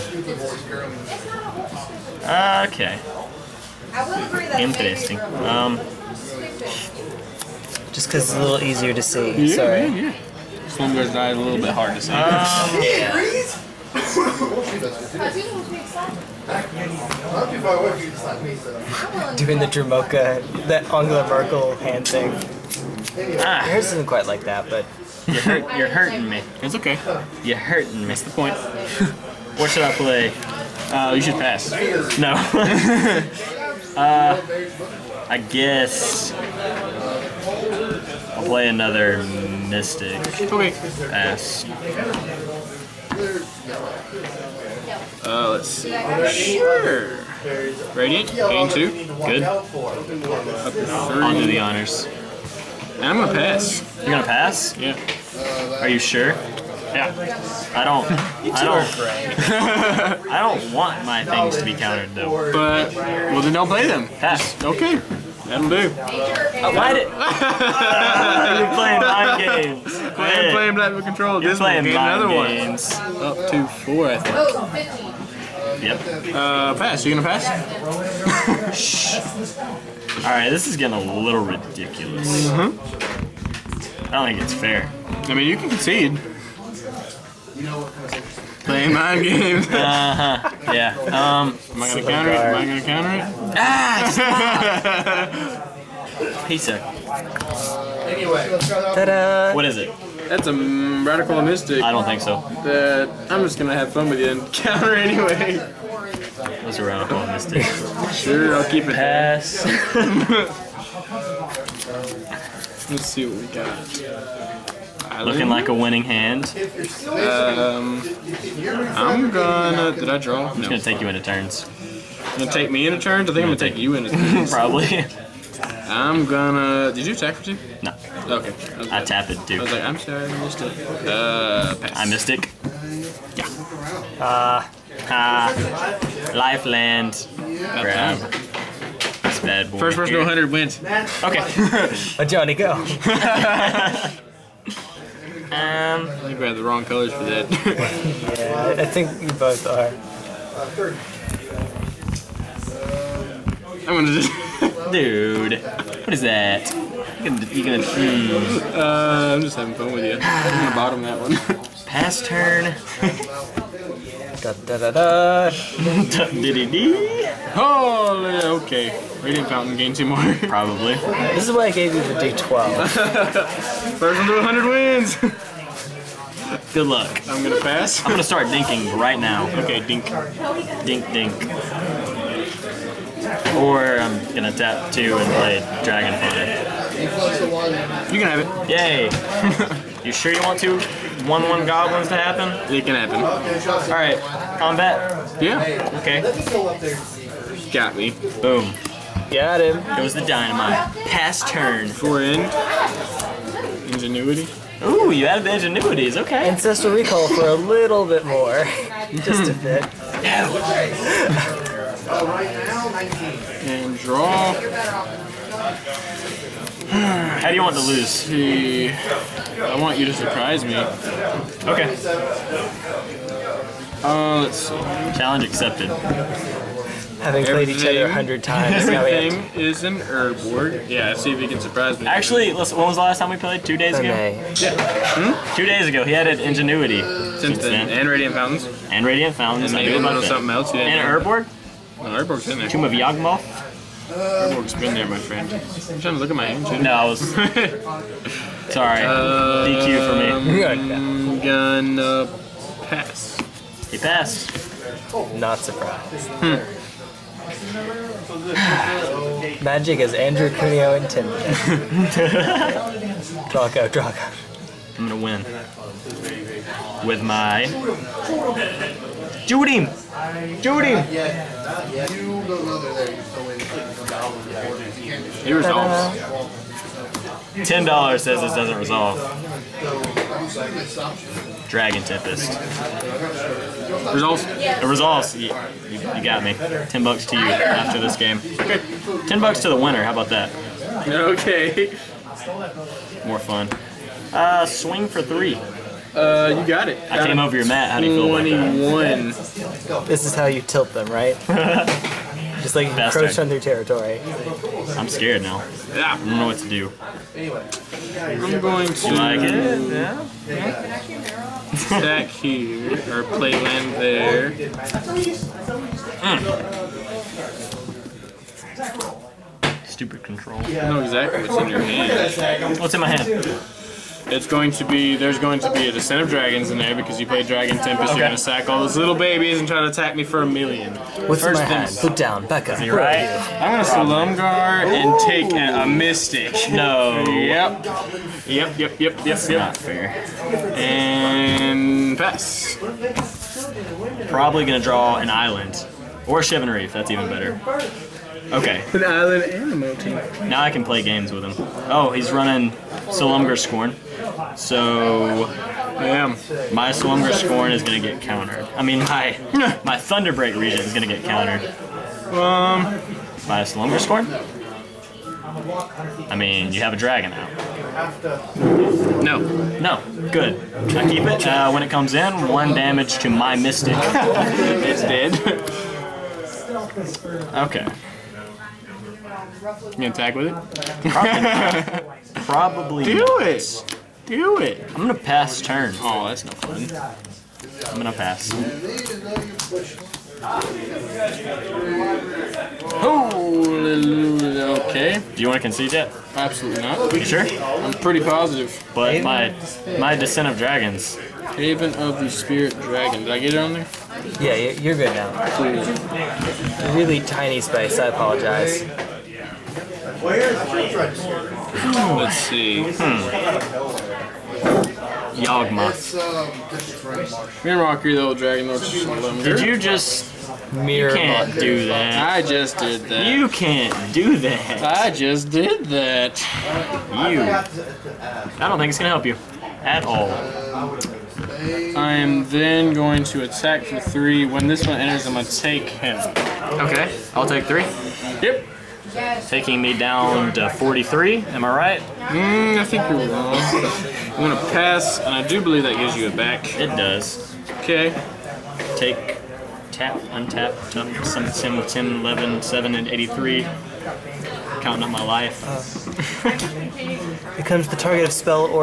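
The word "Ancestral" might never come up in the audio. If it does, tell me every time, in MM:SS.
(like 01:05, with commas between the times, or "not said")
03:26.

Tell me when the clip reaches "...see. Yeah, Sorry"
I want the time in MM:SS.
00:09.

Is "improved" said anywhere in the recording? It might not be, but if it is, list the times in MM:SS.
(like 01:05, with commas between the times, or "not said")
not said.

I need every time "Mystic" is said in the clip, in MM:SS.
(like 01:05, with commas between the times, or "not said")
00:39, 01:41, 01:47, 05:35, 06:13.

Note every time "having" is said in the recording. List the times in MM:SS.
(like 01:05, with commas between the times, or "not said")
02:39, 03:47.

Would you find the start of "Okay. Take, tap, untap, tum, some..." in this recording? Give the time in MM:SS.
07:27.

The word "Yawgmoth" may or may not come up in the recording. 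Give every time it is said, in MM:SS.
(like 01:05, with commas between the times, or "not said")
04:02, 06:55.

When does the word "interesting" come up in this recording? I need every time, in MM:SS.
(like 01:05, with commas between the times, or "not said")
00:04, 01:28.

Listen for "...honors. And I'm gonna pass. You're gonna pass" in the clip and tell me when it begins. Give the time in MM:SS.
00:51.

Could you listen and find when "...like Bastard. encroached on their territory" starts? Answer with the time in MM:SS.
05:02.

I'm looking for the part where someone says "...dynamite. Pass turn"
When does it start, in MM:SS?
03:20.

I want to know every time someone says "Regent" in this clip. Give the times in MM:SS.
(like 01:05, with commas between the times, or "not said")
06:00.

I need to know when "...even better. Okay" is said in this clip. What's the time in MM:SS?
05:47.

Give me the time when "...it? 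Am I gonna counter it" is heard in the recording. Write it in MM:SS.
01:32.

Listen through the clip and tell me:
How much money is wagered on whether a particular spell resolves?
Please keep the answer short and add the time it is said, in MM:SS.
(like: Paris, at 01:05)
10 dollars, at 04:37.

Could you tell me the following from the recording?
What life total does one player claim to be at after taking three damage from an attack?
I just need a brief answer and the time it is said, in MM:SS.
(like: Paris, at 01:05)
43, at 07:20.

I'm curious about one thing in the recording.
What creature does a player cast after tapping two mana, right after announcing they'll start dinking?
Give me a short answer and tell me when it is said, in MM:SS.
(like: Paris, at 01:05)
Dragon Hunter, at 03:05.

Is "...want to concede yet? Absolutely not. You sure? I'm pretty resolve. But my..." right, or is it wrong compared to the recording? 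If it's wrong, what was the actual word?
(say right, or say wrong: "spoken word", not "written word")
wrong: "positive", not "resolve".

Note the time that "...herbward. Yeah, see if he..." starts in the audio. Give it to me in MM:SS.
03:50.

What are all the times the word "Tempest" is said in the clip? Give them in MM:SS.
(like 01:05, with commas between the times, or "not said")
04:42, 05:27.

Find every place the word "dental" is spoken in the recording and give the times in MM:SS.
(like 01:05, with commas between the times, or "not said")
not said.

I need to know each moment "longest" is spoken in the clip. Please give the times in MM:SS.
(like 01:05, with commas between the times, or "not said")
not said.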